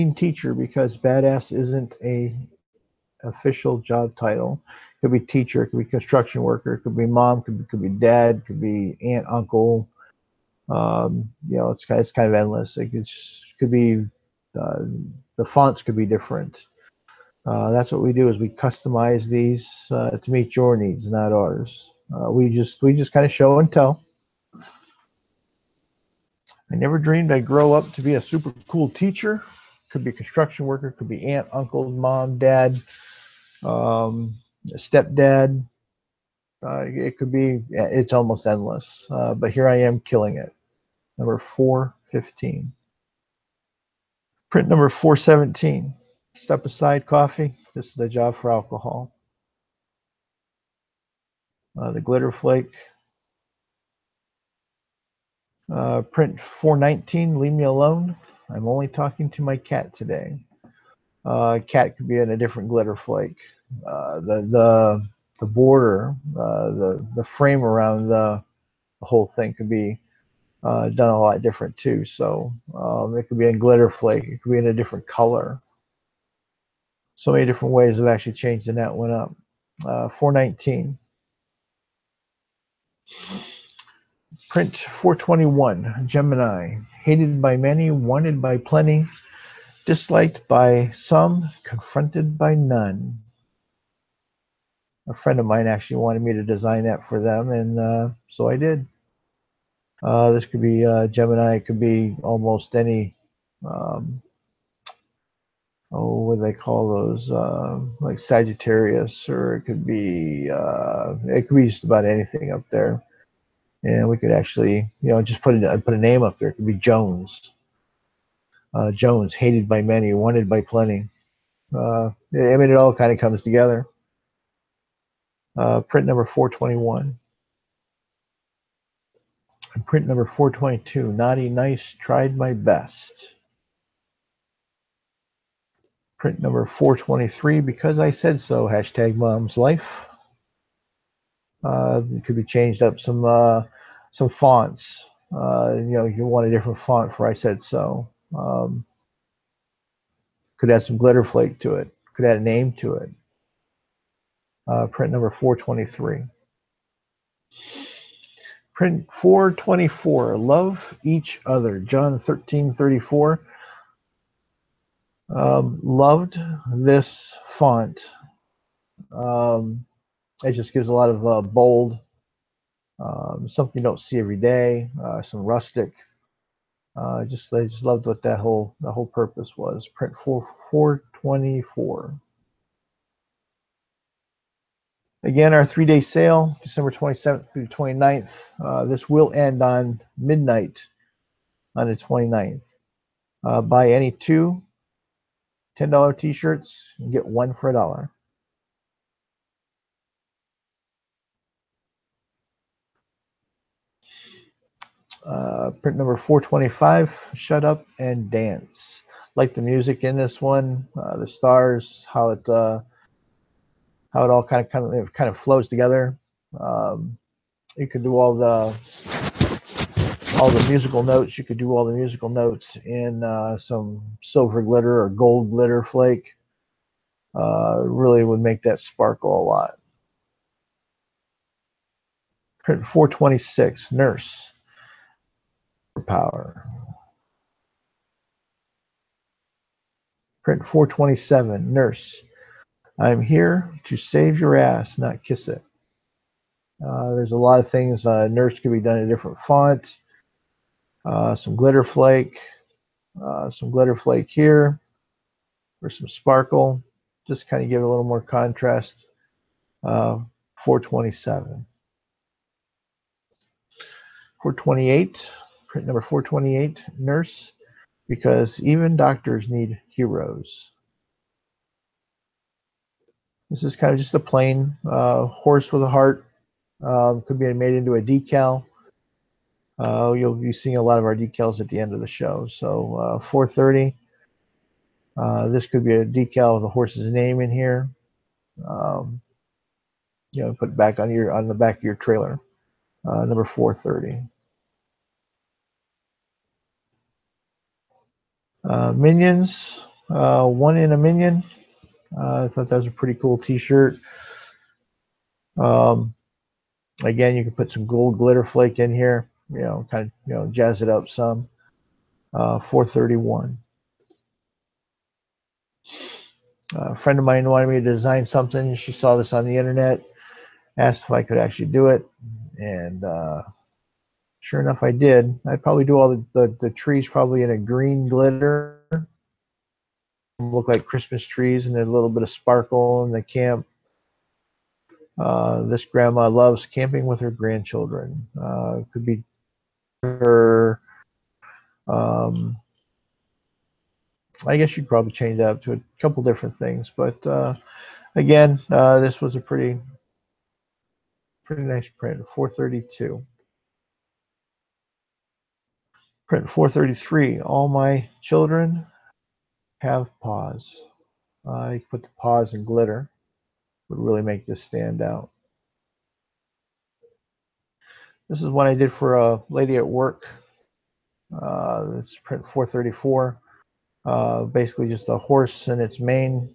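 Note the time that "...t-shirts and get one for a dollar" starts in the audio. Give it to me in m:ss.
3:16.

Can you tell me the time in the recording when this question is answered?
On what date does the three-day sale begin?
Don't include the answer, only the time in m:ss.
3:06.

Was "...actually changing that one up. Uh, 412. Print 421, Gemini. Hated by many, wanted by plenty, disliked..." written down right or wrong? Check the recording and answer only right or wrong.
wrong.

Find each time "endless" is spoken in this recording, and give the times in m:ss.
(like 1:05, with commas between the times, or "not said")
0:12, 0:38.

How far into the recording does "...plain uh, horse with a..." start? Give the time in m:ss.
4:34.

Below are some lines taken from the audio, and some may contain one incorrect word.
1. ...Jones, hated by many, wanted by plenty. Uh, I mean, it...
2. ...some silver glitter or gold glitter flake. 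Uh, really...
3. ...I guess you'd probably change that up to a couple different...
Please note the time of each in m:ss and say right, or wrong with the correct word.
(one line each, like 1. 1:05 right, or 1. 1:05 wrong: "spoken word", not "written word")
1. 1:58 right
2. 3:43 right
3. 5:44 right.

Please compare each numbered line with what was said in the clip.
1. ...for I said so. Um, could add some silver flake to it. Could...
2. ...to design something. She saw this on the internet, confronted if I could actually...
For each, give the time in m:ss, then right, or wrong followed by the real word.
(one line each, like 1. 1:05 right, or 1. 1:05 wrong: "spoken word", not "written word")
1. 2:27 wrong: "glitter", not "silver"
2. 5:17 wrong: "asked", not "confronted".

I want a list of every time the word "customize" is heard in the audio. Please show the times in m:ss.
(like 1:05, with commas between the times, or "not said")
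0:18.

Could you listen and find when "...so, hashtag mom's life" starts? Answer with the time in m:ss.
2:18.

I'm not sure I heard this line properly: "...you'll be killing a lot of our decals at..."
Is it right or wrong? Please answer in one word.
wrong.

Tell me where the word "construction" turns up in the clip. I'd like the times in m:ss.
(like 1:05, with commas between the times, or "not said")
0:05, 0:30.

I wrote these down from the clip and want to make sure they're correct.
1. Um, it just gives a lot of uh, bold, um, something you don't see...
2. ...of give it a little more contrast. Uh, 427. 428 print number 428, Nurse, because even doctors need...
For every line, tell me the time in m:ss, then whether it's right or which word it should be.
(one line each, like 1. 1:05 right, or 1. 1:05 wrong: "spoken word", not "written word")
1. 2:49 right
2. 4:17 right.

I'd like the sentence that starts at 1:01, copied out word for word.
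Uh, cat could be in a different glitter flake.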